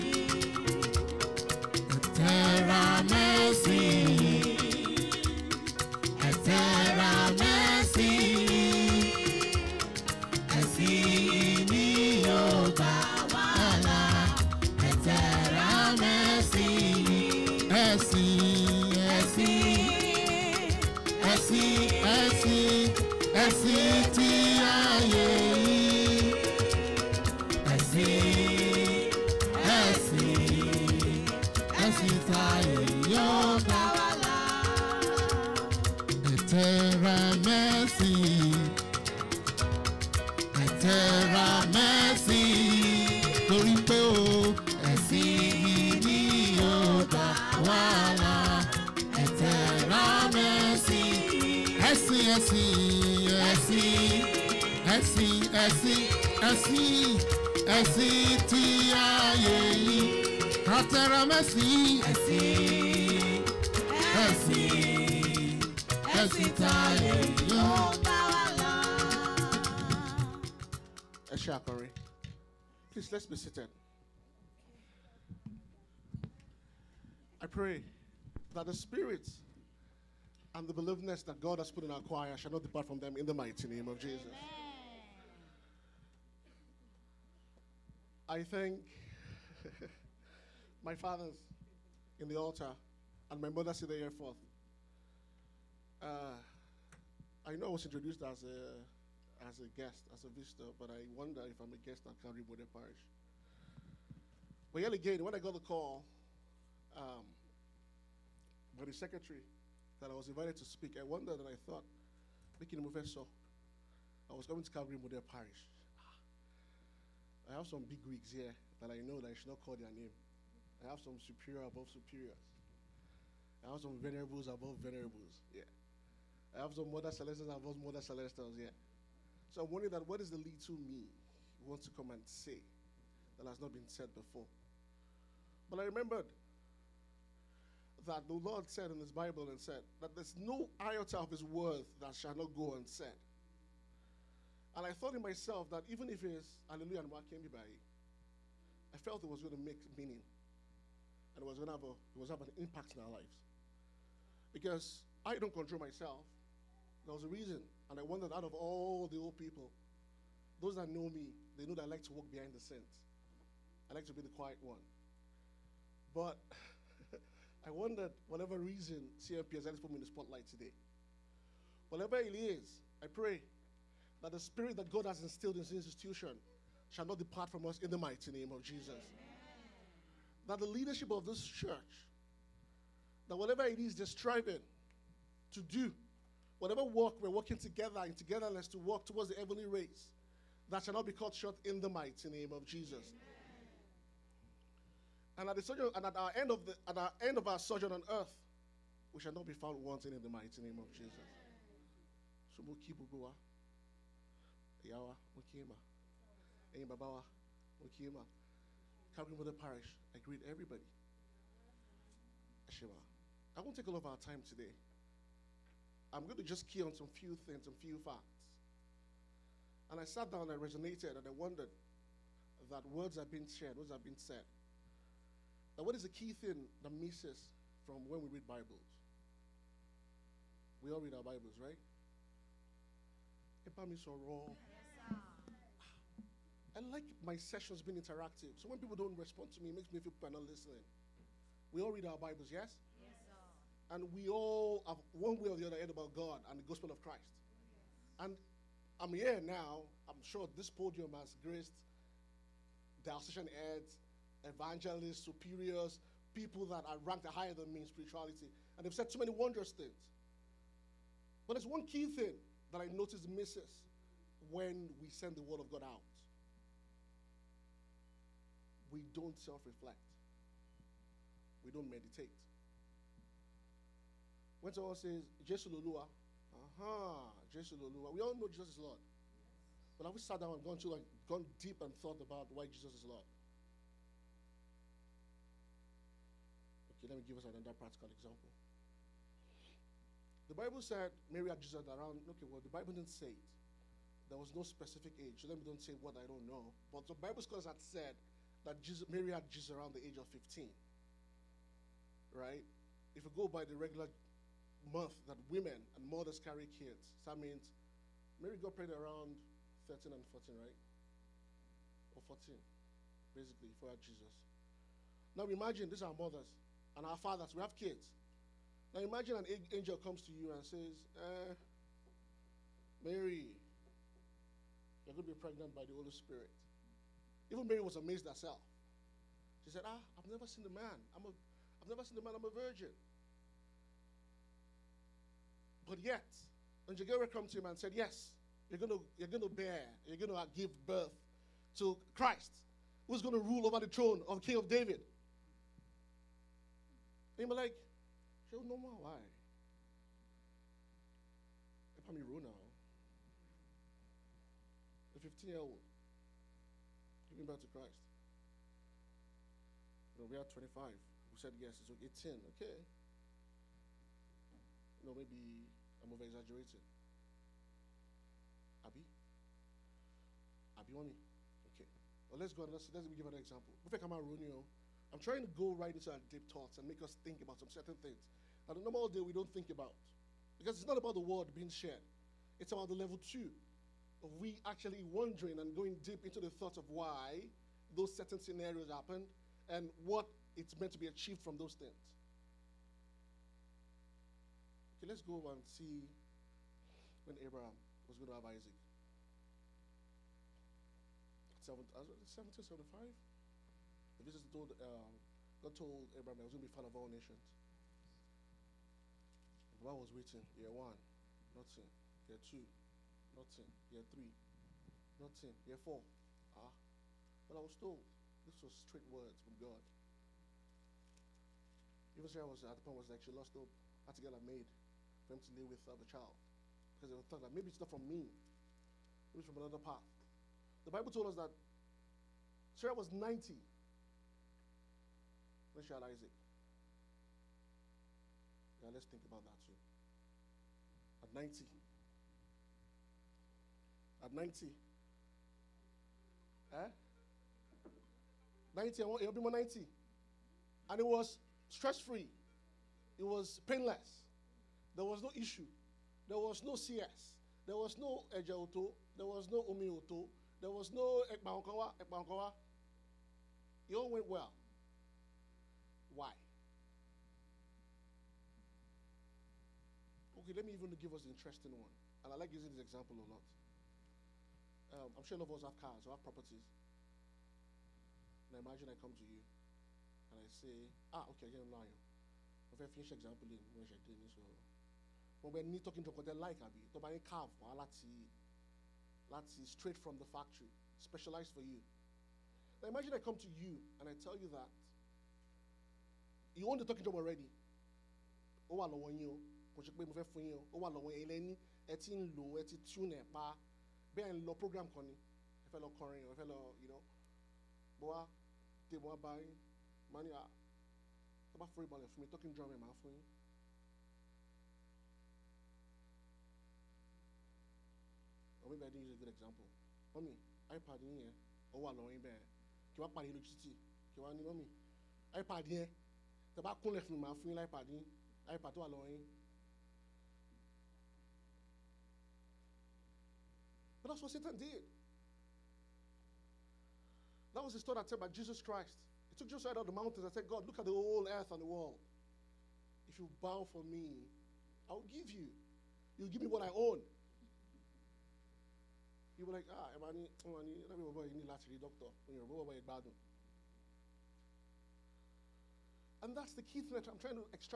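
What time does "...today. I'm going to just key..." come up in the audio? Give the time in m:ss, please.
3:34.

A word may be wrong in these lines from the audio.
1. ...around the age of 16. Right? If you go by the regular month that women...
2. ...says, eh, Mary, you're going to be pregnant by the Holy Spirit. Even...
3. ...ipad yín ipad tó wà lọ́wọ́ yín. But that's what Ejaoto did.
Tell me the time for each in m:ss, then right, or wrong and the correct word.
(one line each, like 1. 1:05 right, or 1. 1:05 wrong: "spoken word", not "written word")
1. 4:59 wrong: "15", not "16"
2. 5:20 right
3. 8:47 wrong: "Satan", not "Ejaoto".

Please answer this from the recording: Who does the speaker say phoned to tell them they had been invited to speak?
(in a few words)
the secretary.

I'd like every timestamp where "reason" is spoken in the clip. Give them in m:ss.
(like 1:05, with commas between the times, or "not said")
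2:37, 2:48.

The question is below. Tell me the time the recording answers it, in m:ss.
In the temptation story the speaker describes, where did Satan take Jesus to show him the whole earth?
8:59.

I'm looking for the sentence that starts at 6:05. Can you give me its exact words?
You know, maybe I'm over exaggerating.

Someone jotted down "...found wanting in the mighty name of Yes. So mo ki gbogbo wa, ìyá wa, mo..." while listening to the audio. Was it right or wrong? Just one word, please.
wrong.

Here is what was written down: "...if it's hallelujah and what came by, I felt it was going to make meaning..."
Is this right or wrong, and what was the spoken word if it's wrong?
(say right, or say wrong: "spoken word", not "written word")
right.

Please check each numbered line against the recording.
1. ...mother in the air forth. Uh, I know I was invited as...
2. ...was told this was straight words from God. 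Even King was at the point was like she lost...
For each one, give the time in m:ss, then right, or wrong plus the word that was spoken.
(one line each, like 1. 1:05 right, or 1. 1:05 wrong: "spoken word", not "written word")
1. 1:33 wrong: "introduced", not "invited"
2. 6:57 wrong: "Sarah", not "King".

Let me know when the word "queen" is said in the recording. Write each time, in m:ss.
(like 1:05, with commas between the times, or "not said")
not said.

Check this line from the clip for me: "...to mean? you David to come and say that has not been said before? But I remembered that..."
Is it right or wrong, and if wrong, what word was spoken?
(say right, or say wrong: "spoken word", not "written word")
wrong: "Wants", not "David".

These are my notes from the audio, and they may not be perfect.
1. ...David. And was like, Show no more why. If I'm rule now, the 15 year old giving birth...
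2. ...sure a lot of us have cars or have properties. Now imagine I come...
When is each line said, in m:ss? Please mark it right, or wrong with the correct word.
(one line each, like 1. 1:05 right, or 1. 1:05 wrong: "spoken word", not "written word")
1. 5:44 right
2. 7:55 right.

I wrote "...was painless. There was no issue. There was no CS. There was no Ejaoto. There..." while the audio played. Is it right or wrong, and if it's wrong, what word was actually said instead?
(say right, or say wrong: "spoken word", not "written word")
right.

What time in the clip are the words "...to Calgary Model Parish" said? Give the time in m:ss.
1:54.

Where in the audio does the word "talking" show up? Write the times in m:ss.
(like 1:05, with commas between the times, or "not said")
8:05, 8:16, 8:32.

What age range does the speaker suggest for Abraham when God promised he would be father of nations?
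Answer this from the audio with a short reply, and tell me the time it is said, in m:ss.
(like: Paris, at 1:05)
70, 75, at 6:42.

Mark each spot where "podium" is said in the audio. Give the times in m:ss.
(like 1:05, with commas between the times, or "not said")
4:10.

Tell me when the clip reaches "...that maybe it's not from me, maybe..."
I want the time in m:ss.
7:07.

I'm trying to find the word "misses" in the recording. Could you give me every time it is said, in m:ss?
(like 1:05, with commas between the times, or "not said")
3:46, 4:23.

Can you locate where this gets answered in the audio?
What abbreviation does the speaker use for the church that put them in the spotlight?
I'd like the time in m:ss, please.
2:49.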